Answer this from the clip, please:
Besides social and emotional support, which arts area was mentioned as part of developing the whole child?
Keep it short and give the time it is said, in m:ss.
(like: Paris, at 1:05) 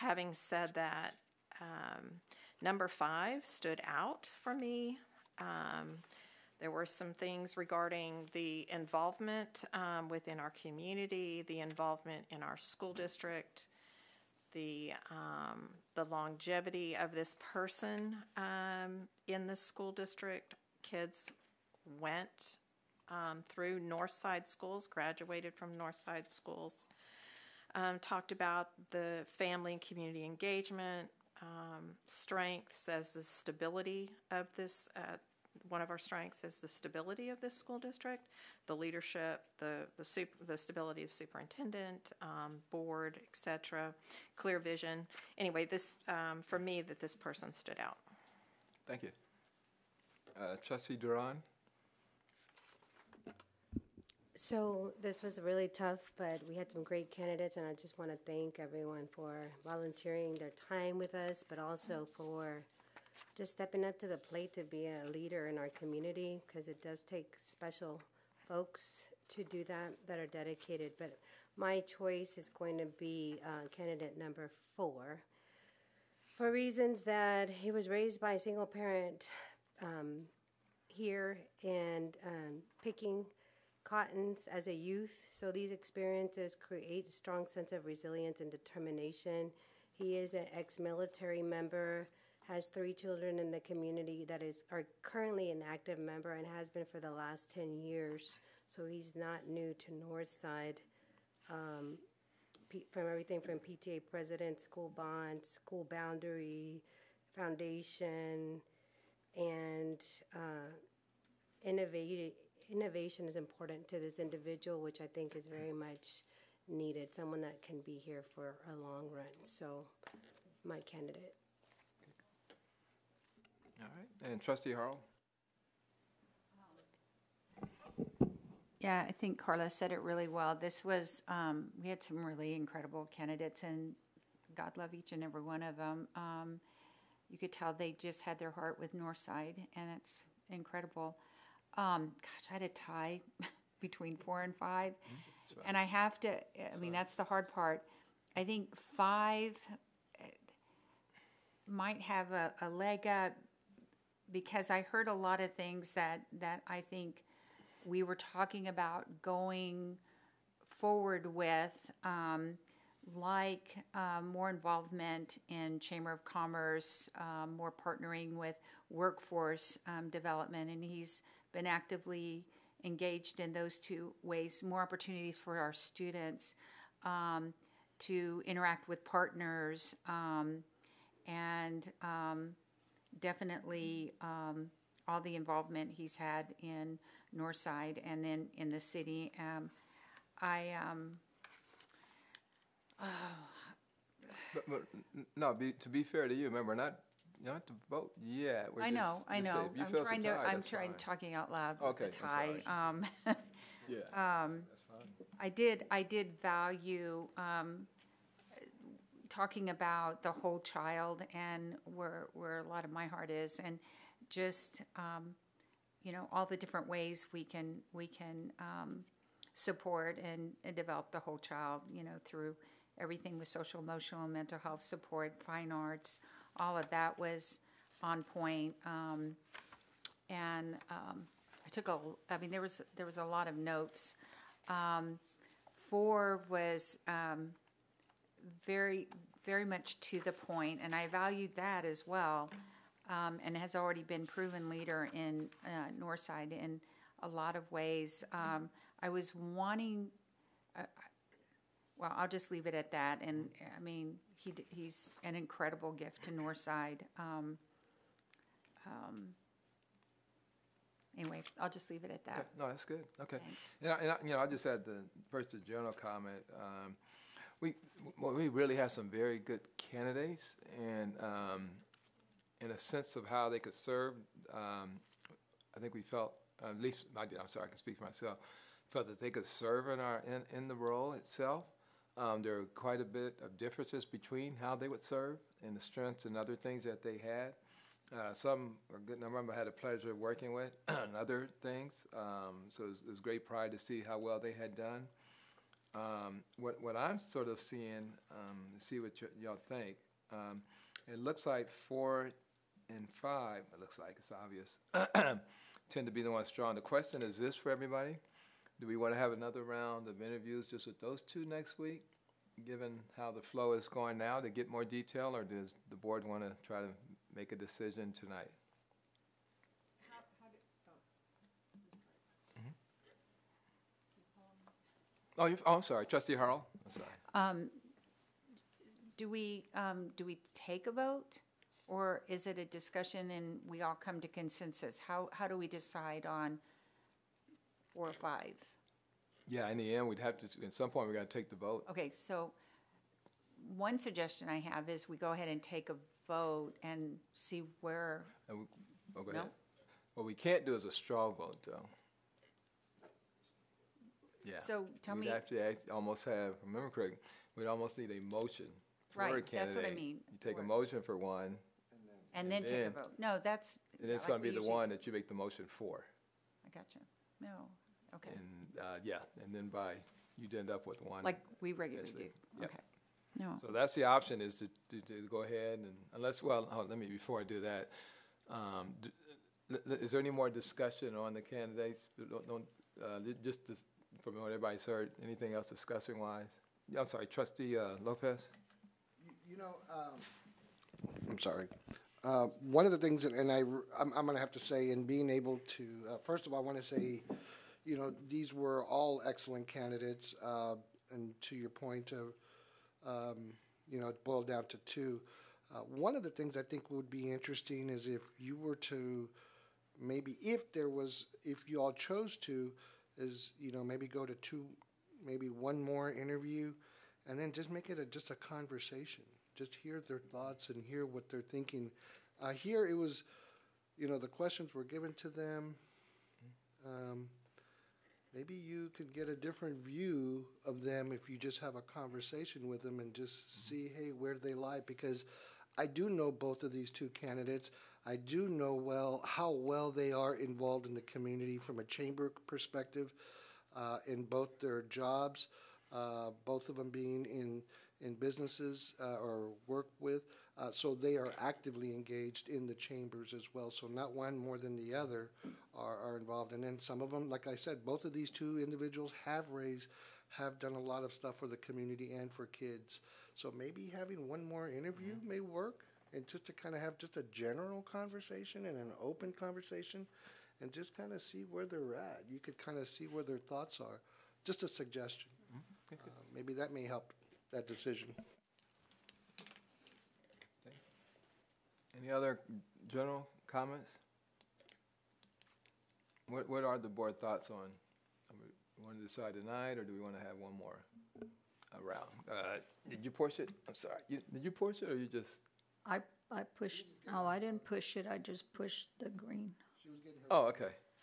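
fine arts, at 3:45.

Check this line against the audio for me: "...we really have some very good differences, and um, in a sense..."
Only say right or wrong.
wrong.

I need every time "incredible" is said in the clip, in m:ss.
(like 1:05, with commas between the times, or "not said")
2:12, 2:20, 4:15.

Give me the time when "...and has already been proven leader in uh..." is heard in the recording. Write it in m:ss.
4:03.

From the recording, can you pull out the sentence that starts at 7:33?
So not one more than the other are, are involved.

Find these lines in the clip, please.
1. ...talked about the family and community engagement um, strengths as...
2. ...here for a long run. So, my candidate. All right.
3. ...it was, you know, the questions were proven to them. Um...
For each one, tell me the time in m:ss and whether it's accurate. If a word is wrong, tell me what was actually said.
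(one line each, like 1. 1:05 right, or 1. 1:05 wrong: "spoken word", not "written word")
1. 0:27 right
2. 1:58 right
3. 7:02 wrong: "given", not "proven".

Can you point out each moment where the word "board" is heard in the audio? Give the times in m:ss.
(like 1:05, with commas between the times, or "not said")
0:42, 5:15, 8:06.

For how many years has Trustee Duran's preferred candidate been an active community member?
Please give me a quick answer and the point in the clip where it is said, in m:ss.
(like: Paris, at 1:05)
10, at 1:37.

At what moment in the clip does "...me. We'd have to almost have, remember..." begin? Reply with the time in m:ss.
5:55.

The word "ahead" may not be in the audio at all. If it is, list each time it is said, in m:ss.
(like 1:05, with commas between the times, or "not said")
5:45, 5:49, 6:15.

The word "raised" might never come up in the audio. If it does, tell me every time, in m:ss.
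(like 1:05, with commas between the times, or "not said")
1:17, 7:39.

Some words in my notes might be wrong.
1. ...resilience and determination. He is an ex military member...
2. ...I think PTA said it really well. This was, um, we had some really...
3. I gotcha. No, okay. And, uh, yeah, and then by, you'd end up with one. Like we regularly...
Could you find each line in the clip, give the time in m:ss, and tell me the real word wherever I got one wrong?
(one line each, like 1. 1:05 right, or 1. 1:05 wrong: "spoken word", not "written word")
1. 1:27 right
2. 2:09 wrong: "Carla", not "PTA"
3. 6:06 right.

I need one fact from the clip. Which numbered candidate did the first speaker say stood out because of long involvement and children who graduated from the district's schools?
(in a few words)
5.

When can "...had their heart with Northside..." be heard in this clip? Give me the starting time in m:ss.
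2:18.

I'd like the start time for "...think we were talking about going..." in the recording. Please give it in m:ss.
2:36.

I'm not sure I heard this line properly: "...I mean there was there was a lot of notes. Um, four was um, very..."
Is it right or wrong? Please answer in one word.
right.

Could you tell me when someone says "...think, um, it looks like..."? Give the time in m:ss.
4:59.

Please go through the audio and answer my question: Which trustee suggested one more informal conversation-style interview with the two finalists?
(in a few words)
Lopez.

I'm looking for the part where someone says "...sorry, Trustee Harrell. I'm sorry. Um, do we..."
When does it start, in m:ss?
5:25.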